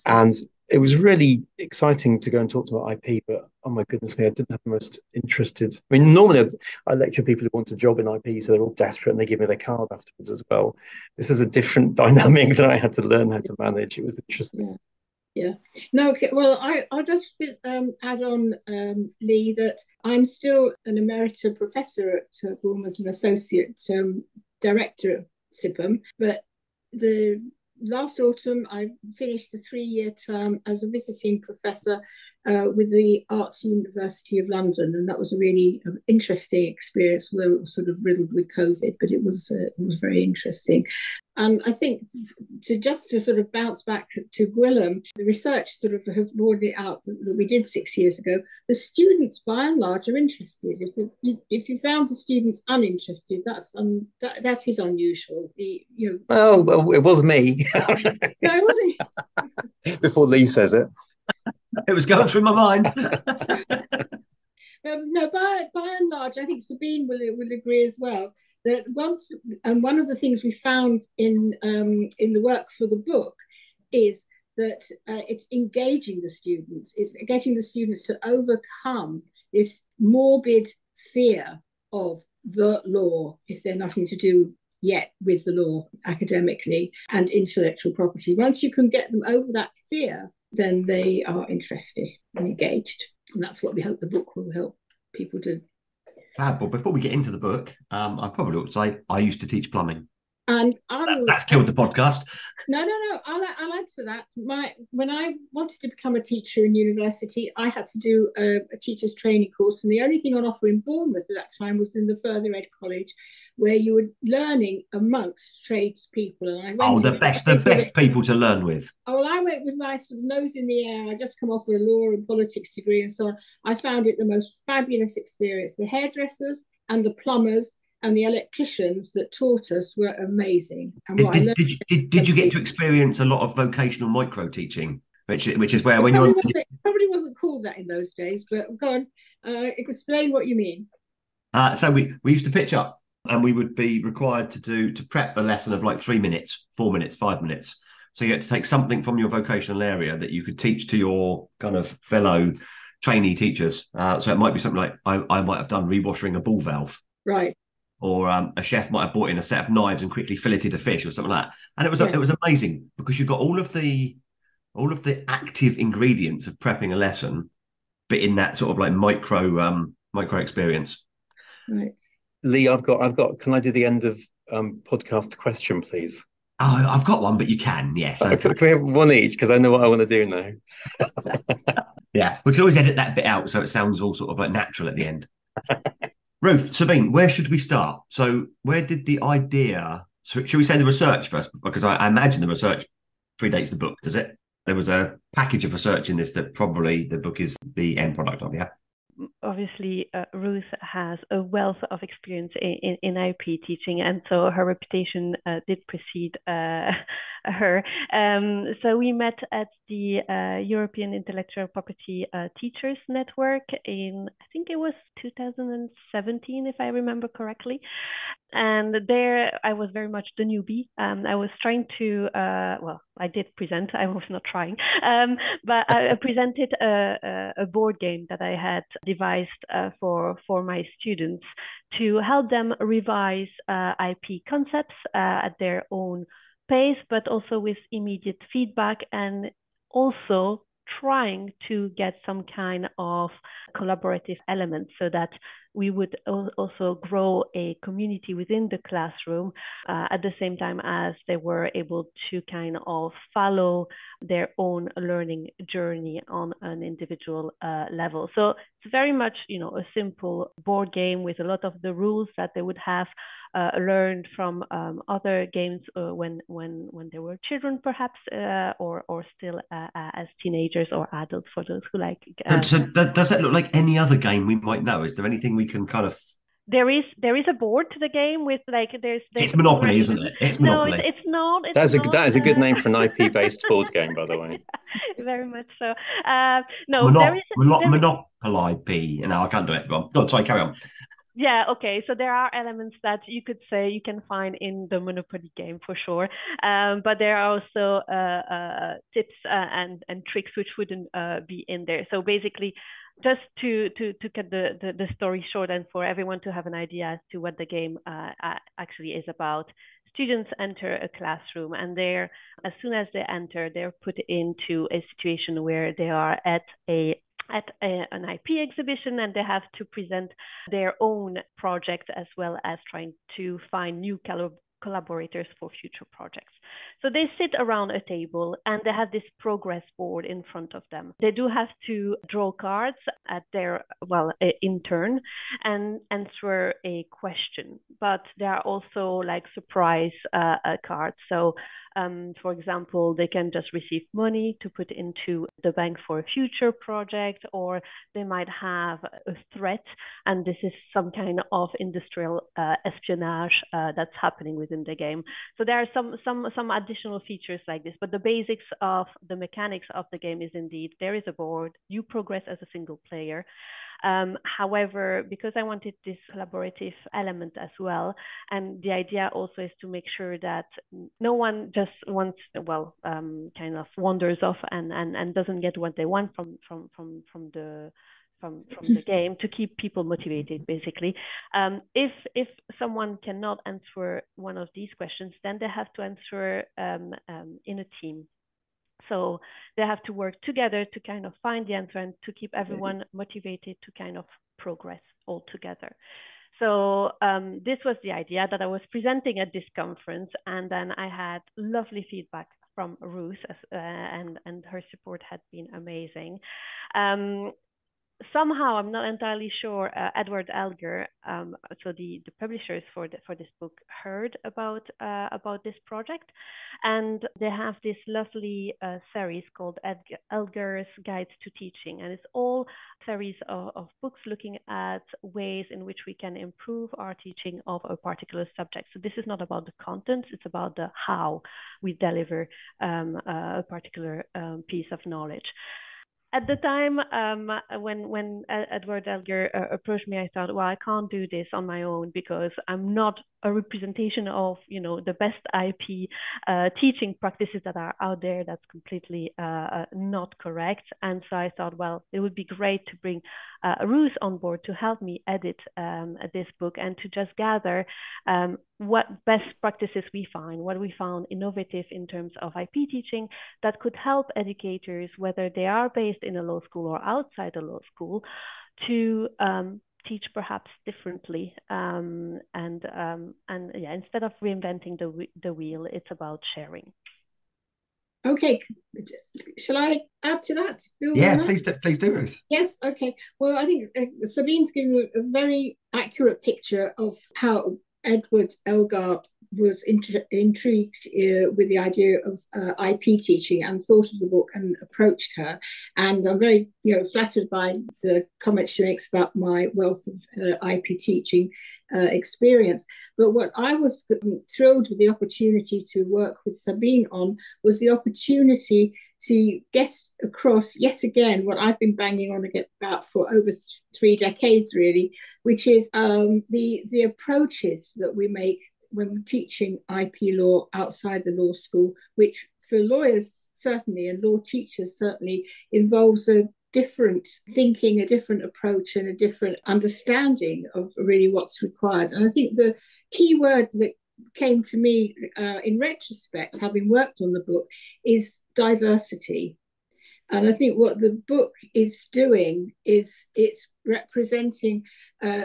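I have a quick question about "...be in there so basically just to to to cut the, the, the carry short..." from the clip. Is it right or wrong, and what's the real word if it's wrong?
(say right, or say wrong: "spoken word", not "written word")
wrong: "story", not "carry".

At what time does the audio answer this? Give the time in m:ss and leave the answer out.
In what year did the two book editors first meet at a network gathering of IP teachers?
3:35.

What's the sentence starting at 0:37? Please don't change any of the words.
Although it was sort of riddled with COVID, but it was uh, it was very interesting.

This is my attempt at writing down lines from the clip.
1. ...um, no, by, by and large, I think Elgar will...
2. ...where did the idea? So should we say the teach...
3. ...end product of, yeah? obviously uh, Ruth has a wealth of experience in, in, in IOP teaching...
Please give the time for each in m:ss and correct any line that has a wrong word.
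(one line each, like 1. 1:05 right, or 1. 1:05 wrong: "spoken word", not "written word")
1. 1:02 wrong: "Sabine", not "Elgar"
2. 3:08 wrong: "research", not "teach"
3. 3:17 right.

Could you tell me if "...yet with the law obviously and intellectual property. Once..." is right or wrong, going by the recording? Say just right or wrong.
wrong.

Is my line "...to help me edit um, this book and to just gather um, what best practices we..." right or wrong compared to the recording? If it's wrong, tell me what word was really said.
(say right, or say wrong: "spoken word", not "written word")
right.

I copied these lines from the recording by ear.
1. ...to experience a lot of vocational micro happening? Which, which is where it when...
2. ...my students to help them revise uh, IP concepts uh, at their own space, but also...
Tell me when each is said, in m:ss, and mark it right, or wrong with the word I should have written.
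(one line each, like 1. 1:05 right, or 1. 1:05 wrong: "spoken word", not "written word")
1. 2:12 wrong: "teaching", not "happening"
2. 3:50 right.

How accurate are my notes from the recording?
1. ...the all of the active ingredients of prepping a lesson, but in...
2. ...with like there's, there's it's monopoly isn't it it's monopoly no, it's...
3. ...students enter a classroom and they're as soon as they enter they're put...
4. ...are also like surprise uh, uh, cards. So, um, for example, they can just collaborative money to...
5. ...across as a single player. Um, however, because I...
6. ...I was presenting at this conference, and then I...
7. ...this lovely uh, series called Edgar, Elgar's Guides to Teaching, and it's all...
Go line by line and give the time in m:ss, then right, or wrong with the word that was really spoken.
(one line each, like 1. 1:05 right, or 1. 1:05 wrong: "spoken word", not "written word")
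1. 2:43 right
2. 4:38 right
3. 5:10 right
4. 5:38 wrong: "receive", not "collaborative"
5. 6:02 wrong: "progress", not "across"
6. 6:38 right
7. 6:57 right.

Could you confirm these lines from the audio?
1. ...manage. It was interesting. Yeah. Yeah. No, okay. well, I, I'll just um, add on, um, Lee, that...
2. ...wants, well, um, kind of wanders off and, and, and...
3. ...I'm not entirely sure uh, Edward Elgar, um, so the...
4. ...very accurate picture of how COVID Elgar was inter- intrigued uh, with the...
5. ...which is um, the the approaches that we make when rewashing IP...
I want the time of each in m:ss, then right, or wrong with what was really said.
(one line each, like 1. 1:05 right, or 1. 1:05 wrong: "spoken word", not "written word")
1. 0:13 right
2. 6:12 right
3. 6:48 right
4. 8:05 wrong: "Edward", not "COVID"
5. 8:35 wrong: "teaching", not "rewashing".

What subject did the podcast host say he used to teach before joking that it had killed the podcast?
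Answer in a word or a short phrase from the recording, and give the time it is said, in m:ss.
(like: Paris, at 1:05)
plumbing, at 1:39.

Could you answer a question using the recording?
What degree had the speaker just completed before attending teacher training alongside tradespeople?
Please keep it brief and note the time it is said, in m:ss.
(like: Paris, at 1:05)
law and politics, at 2:01.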